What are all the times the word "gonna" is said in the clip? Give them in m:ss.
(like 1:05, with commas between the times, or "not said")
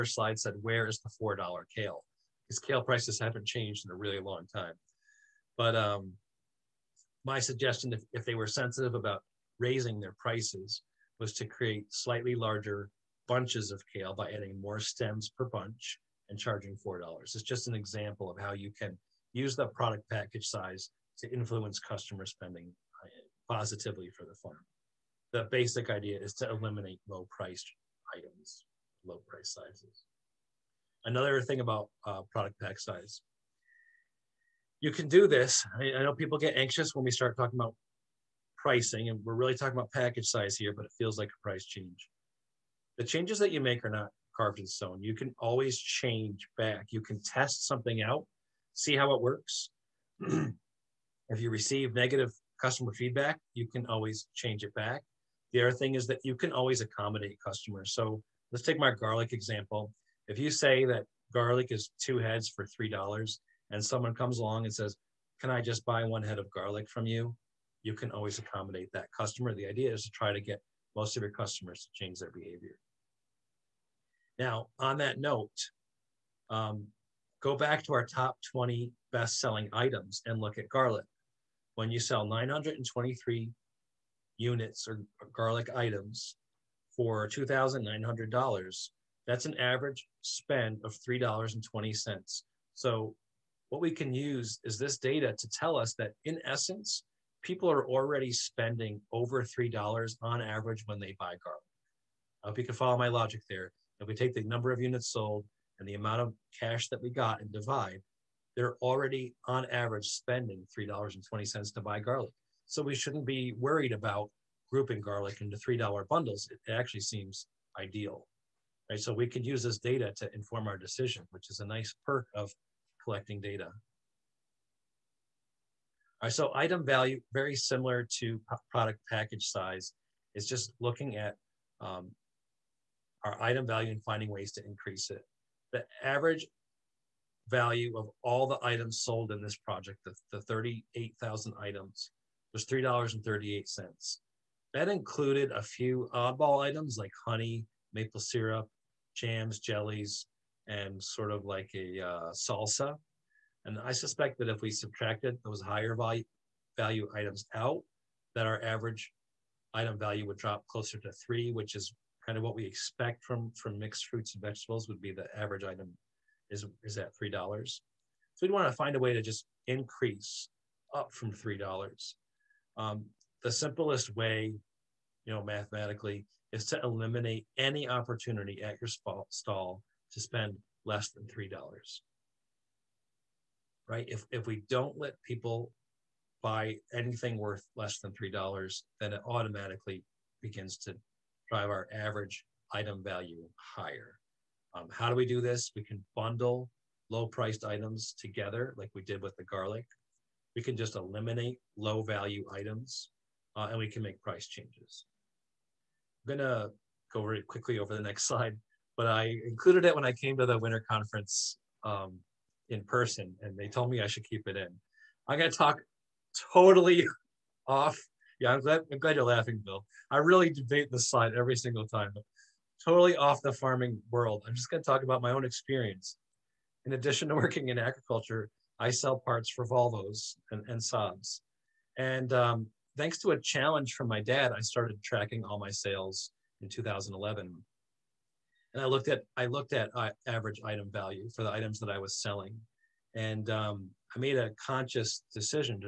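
3:26, 3:35, 3:44.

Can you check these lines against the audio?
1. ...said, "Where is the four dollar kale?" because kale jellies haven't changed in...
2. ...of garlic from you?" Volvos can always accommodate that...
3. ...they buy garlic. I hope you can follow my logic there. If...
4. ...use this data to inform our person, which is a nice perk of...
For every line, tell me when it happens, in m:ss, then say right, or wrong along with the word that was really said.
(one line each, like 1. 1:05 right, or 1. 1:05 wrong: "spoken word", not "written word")
1. 0:00 wrong: "prices", not "jellies"
2. 1:06 wrong: "You", not "Volvos"
3. 1:40 right
4. 1:59 wrong: "decision", not "person".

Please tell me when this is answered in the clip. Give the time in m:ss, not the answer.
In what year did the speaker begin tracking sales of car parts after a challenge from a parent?
3:56.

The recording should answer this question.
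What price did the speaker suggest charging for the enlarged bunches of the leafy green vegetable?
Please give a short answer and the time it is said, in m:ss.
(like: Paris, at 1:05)
$4, at 0:16.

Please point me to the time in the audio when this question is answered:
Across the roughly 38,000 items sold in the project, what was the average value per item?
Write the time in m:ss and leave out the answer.
2:22.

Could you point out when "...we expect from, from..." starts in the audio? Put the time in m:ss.
2:42.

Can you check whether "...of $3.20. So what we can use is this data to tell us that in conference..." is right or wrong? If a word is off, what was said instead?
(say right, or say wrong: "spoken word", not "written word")
wrong: "essence", not "conference".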